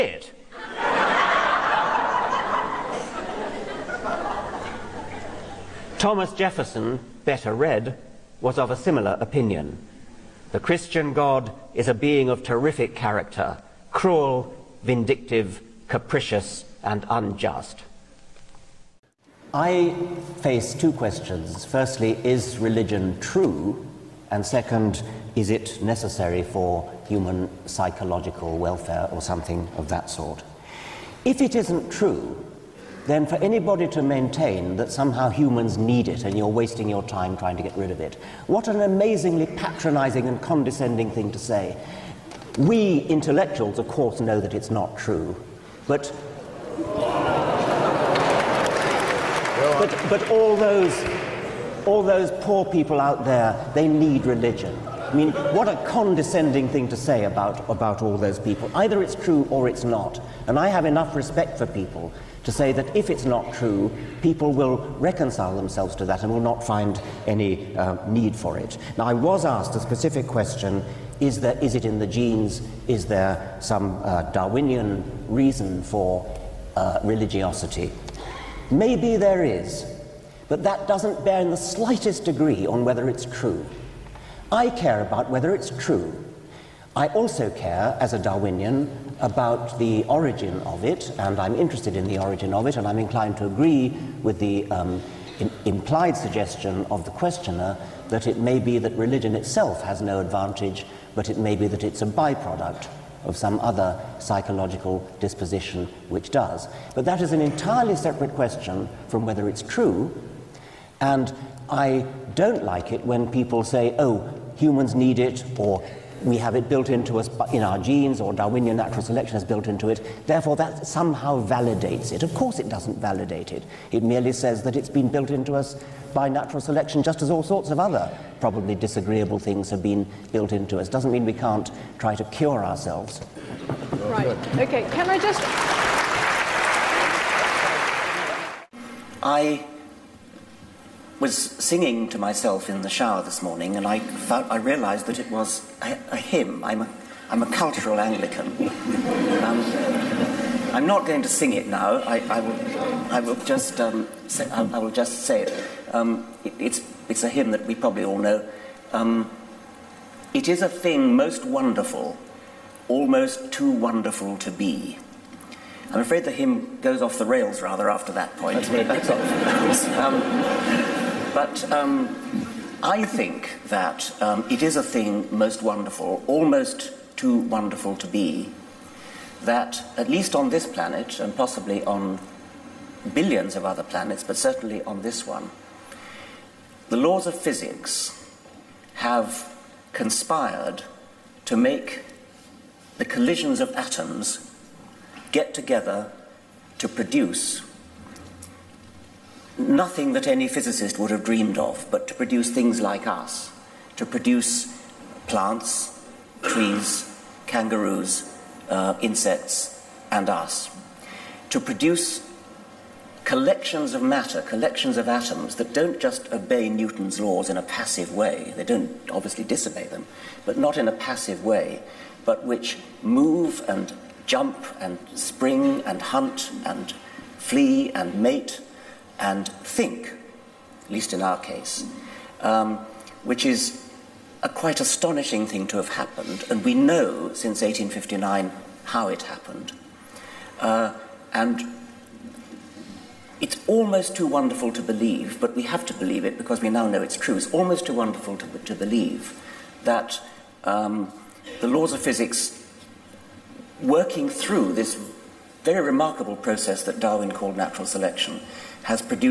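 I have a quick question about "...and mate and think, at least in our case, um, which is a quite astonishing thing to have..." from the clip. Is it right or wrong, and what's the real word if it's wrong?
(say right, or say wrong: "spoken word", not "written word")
right.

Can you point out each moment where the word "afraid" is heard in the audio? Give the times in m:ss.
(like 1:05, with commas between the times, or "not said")
2:46.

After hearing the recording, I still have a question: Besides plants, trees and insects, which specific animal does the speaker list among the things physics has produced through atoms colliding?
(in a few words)
Kangaroos.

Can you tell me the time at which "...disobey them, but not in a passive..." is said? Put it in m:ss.
3:39.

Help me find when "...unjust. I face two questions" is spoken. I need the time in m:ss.
0:17.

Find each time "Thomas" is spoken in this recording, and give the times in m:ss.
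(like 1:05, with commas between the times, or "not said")
0:05.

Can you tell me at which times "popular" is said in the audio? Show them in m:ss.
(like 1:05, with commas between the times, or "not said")
not said.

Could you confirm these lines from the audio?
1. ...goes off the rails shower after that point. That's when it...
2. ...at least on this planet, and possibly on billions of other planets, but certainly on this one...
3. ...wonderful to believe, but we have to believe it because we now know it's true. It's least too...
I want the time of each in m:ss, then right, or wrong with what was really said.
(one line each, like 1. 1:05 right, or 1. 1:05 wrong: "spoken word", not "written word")
1. 2:46 wrong: "rather", not "shower"
2. 2:59 right
3. 4:04 wrong: "almost", not "least".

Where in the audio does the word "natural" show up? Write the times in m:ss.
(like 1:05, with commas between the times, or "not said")
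1:58, 2:06, 4:17.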